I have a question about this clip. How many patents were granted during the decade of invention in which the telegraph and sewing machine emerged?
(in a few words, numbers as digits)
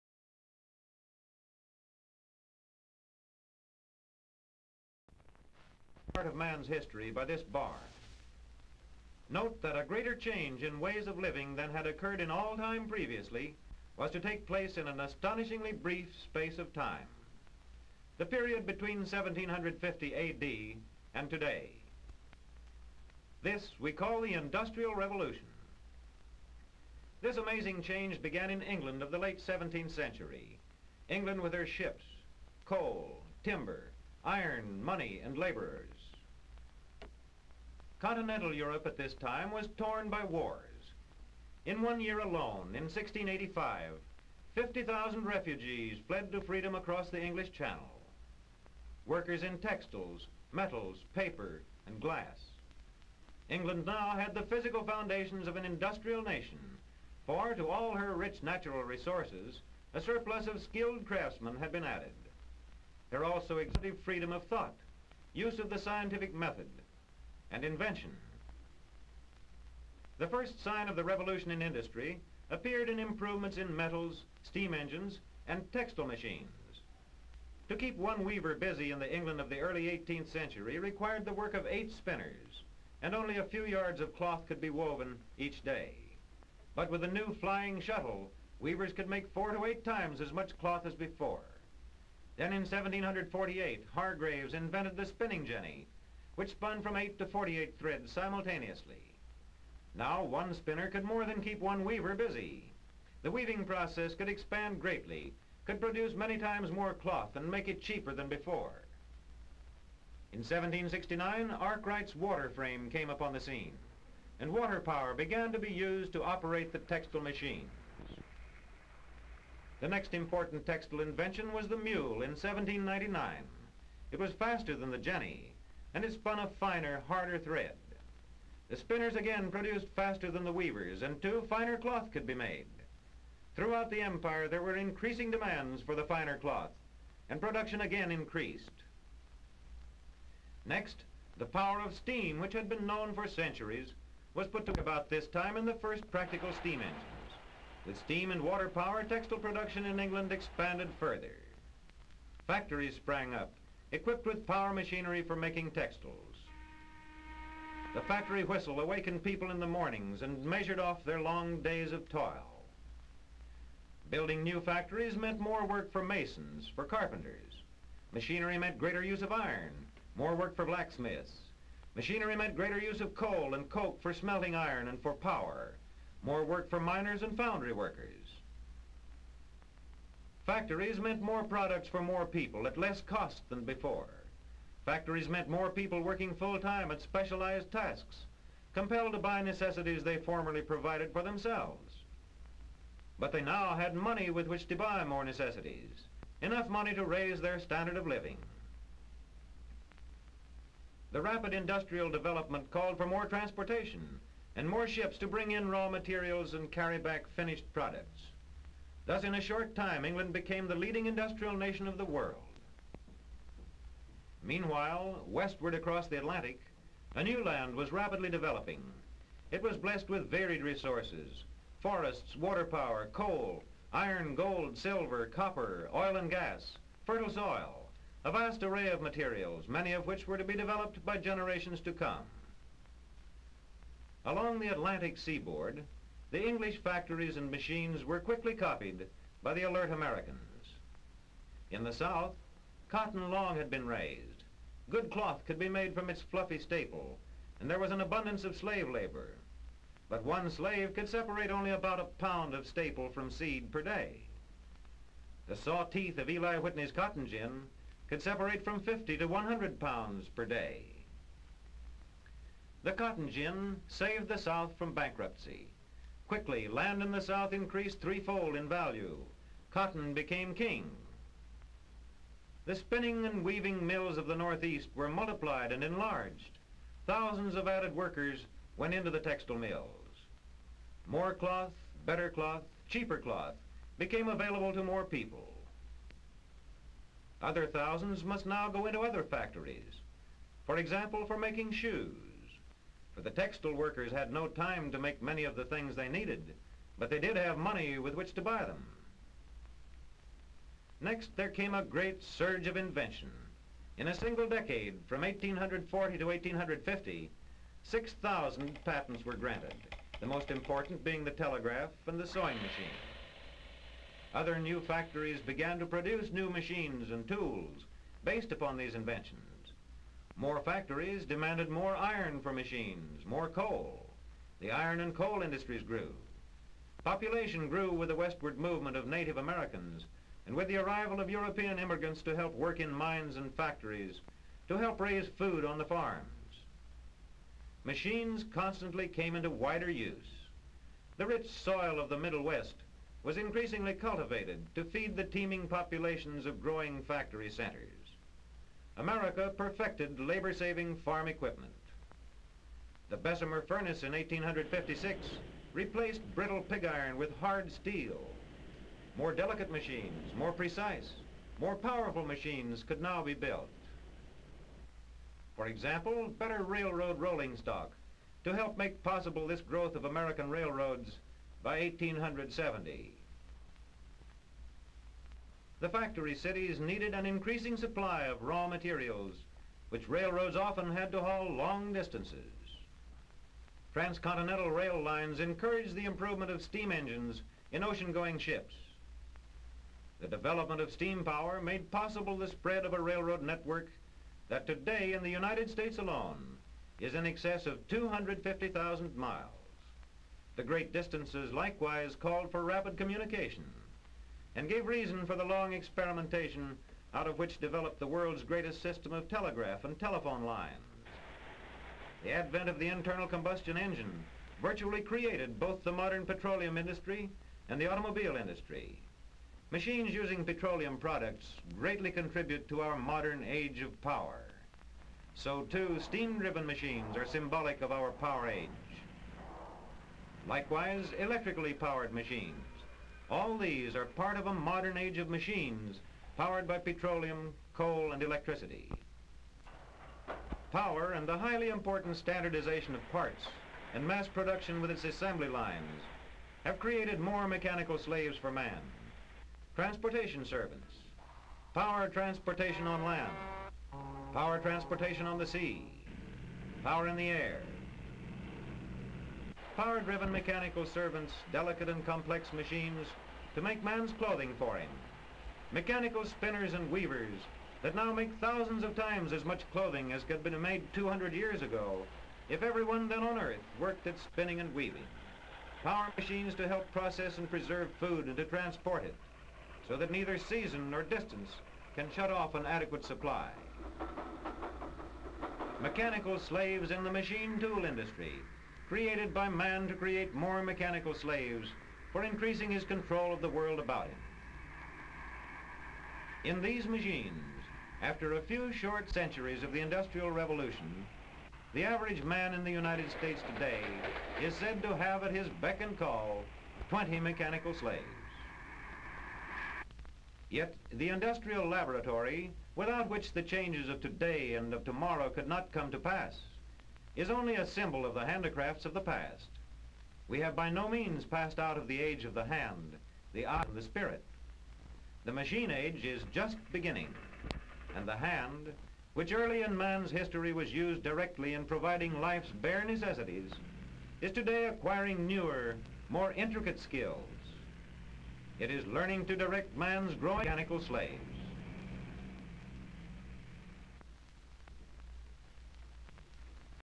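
6,000.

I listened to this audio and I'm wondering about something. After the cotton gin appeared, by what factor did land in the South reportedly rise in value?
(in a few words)
threefold.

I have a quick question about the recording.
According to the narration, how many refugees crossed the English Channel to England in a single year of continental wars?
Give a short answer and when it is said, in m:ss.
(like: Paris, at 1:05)
50,000, at 0:44.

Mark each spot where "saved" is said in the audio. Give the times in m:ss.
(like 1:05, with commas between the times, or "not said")
4:23.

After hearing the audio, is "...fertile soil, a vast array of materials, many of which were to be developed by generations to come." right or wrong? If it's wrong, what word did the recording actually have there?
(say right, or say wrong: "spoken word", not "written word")
right.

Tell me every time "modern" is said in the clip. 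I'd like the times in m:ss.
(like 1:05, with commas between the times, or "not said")
6:55, 7:02, 7:14.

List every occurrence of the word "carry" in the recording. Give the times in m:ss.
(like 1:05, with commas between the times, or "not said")
3:26.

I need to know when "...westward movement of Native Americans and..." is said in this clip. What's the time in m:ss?
5:28.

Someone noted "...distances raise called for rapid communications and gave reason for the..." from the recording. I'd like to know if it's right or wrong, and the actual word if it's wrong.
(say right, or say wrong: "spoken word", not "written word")
wrong: "likewise", not "raise".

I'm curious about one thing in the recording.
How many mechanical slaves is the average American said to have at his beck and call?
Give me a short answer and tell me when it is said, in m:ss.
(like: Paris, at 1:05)
20, at 8:26.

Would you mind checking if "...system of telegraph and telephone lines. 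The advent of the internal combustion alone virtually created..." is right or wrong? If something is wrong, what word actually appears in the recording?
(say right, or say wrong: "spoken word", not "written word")
wrong: "engine", not "alone".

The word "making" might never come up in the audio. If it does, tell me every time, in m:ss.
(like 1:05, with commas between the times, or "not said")
2:35, 4:51.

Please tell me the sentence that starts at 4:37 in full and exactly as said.
Thousands of added workers went into the textile mills.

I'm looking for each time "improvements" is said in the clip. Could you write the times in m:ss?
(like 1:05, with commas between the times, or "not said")
1:12, 6:26.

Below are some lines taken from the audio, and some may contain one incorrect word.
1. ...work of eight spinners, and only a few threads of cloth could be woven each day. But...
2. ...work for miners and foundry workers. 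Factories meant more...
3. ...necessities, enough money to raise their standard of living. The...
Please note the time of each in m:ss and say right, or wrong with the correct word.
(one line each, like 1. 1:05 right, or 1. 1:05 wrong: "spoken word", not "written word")
1. 1:21 wrong: "yards", not "threads"
2. 2:56 right
3. 3:15 right.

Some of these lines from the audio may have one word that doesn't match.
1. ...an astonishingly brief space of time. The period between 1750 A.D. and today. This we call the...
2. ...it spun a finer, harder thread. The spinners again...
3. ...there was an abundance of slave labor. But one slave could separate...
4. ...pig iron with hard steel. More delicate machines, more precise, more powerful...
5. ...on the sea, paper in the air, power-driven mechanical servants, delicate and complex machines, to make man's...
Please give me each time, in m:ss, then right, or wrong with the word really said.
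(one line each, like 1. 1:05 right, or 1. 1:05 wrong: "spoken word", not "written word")
1. 0:14 right
2. 2:06 right
3. 4:07 right
4. 5:56 right
5. 7:35 wrong: "power", not "paper".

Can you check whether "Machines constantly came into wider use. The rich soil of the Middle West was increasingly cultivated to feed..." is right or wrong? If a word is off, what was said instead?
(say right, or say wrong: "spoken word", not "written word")
right.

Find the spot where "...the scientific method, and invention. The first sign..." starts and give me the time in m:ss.
1:05.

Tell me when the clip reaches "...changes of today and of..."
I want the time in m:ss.
8:33.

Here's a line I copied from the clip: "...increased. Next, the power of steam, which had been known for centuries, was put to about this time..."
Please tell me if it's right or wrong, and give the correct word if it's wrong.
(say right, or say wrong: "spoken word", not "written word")
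right.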